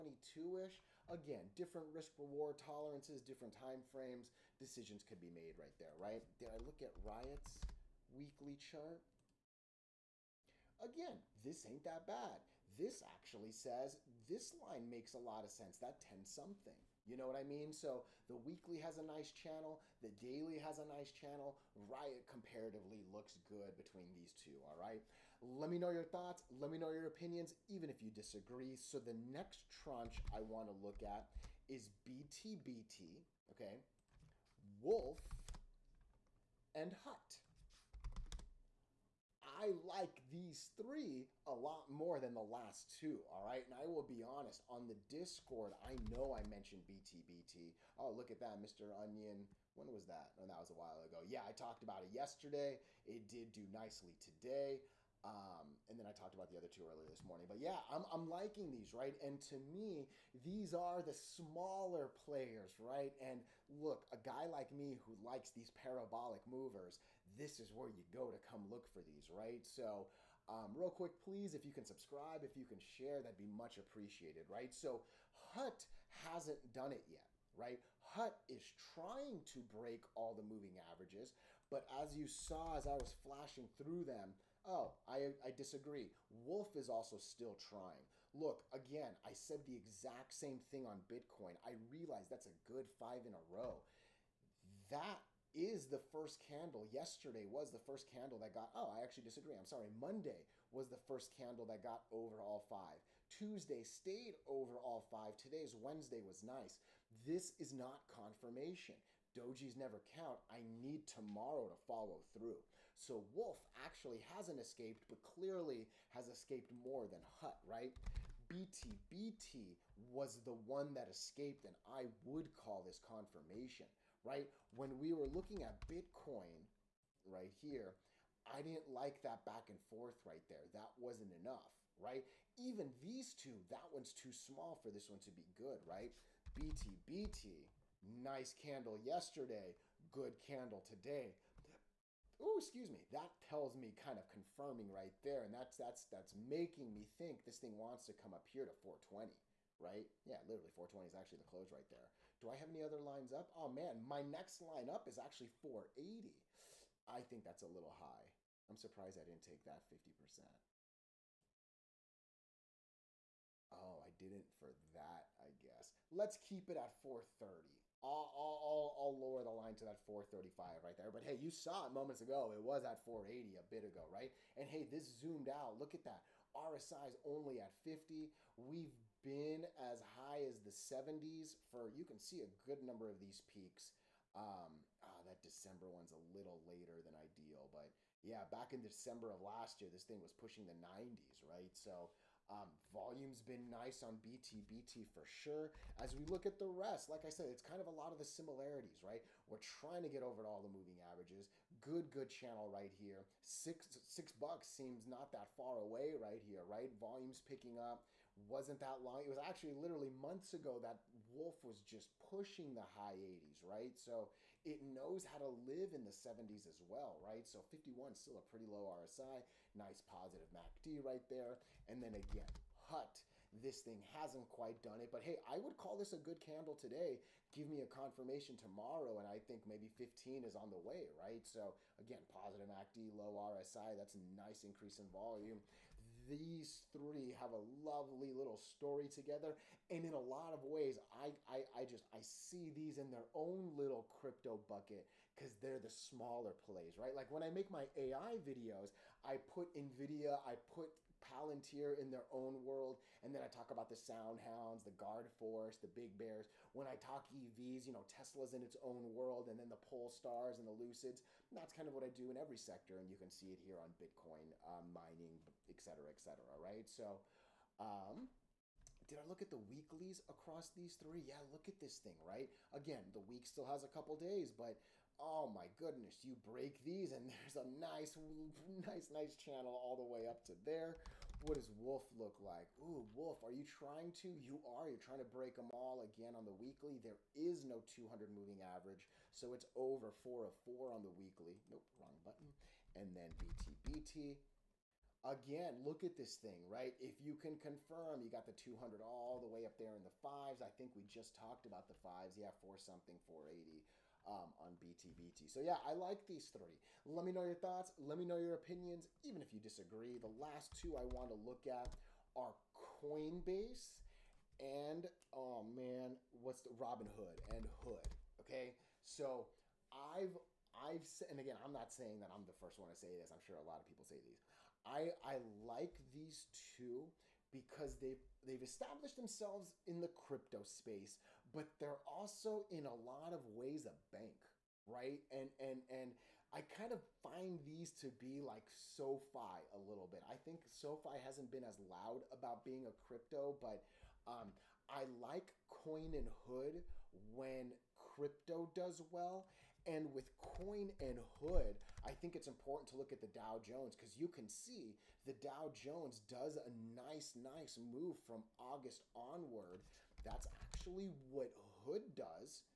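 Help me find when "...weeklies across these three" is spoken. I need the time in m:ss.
4:29.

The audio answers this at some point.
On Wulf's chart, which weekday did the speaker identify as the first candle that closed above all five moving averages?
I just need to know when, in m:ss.
1:39.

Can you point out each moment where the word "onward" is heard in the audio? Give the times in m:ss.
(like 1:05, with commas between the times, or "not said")
5:59.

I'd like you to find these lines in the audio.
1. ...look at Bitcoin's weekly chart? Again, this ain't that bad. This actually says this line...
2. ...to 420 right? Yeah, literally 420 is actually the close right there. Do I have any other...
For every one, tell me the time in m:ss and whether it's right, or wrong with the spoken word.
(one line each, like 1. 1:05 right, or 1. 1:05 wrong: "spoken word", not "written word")
1. 0:06 wrong: "Riot", not "Bitcoin"
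2. 2:28 right.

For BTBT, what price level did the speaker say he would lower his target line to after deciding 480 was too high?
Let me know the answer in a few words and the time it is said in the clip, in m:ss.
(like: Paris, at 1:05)
435, at 2:50.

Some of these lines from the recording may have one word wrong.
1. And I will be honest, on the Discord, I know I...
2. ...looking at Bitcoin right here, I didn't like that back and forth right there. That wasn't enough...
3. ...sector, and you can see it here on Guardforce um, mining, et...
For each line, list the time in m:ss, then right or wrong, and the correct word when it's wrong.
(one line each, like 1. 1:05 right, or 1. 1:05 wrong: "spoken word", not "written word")
1. 0:43 right
2. 2:05 right
3. 4:22 wrong: "Bitcoin", not "Guardforce".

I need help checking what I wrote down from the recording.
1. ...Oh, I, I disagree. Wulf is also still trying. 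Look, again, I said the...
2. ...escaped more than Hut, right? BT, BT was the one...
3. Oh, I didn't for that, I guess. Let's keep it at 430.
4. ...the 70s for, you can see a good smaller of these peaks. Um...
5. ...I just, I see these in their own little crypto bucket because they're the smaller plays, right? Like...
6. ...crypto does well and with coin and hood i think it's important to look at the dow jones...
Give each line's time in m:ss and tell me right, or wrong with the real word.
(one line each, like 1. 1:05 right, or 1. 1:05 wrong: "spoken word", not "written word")
1. 1:24 right
2. 1:56 right
3. 2:43 right
4. 3:00 wrong: "number", not "smaller"
5. 4:01 right
6. 5:47 right.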